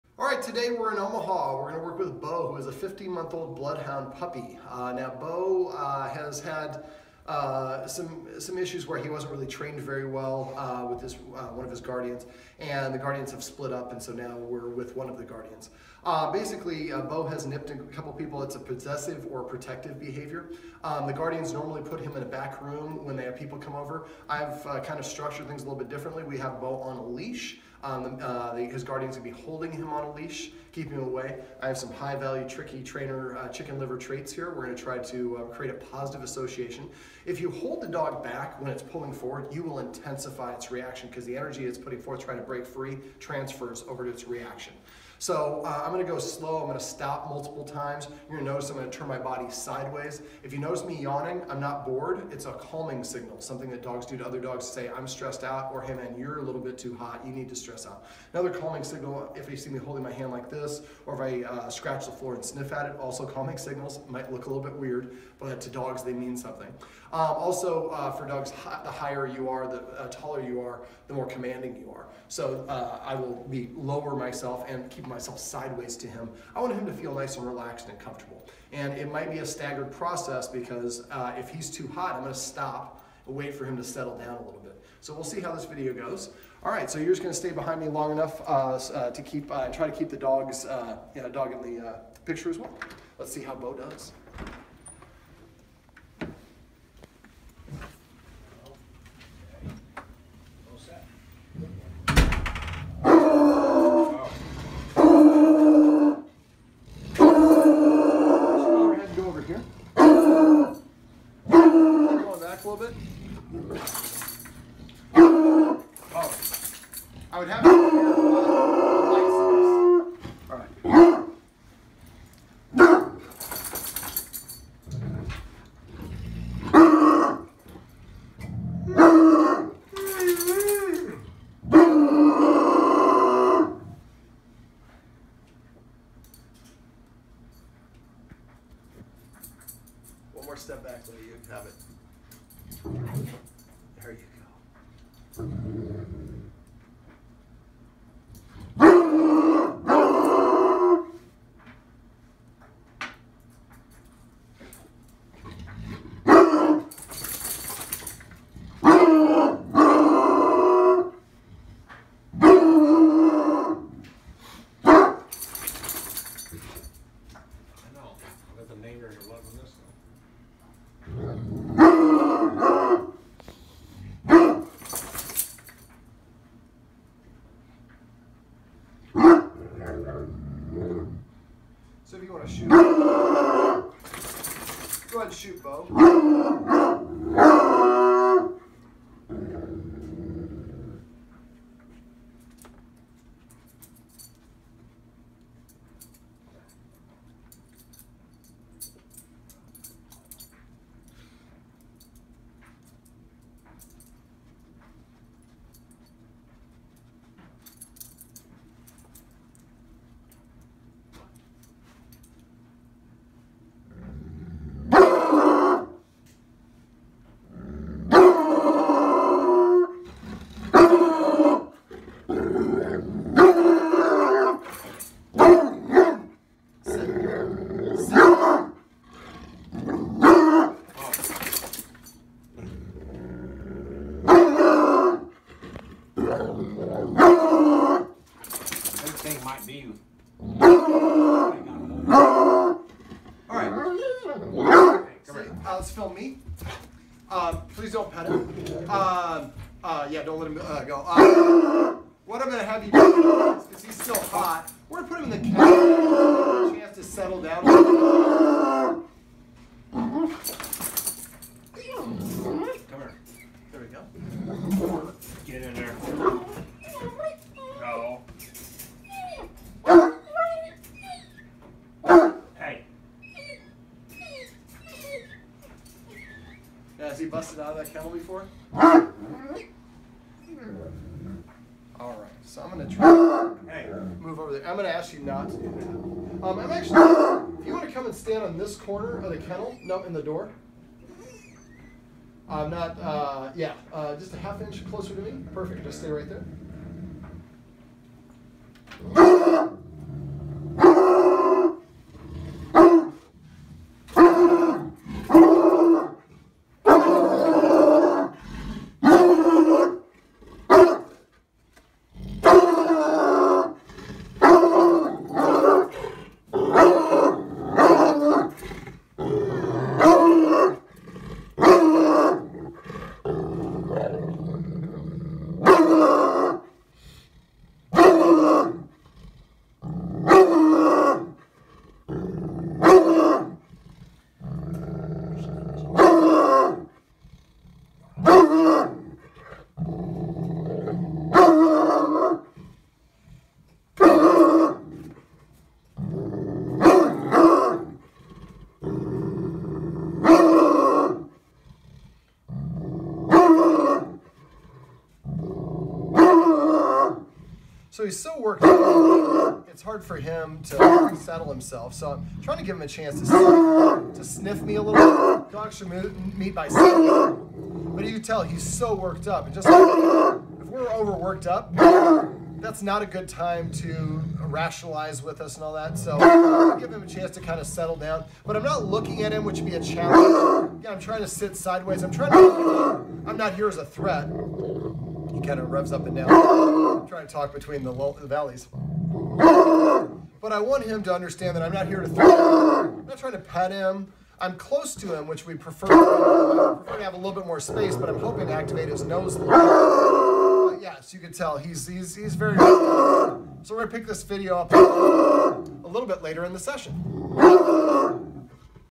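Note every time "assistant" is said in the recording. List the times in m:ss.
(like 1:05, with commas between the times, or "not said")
not said.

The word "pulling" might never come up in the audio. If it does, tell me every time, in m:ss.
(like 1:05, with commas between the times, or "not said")
0:38.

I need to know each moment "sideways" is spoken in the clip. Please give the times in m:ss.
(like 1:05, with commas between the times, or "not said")
0:49, 1:15, 6:21.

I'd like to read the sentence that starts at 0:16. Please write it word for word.
Uh, basically, uh, Bo has nipped a couple people.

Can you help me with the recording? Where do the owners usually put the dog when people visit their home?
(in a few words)
A back room.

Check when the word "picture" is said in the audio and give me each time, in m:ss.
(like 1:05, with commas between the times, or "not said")
1:32.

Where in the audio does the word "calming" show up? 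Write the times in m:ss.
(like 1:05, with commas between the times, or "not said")
0:52, 0:58, 1:03.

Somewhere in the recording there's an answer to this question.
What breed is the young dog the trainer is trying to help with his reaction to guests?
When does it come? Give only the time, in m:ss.
0:03.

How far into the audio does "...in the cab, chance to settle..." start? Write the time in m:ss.
4:15.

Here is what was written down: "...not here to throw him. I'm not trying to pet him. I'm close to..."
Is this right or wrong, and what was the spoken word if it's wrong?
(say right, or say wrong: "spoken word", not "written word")
right.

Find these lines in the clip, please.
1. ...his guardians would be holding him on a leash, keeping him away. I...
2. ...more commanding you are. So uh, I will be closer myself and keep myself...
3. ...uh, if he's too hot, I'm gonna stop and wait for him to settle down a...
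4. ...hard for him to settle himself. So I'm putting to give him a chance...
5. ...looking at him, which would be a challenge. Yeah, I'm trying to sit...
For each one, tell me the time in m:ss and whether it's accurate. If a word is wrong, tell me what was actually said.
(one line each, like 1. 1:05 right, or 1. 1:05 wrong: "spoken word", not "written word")
1. 0:28 right
2. 1:11 wrong: "lower", not "closer"
3. 1:21 right
4. 5:59 wrong: "trying", not "putting"
5. 6:18 right.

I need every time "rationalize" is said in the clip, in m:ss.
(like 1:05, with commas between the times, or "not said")
6:14.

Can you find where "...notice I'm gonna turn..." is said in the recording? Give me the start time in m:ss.
0:48.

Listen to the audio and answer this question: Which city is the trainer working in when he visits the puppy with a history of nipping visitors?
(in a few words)
Omaha.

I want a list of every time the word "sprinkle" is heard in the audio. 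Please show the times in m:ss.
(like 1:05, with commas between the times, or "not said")
not said.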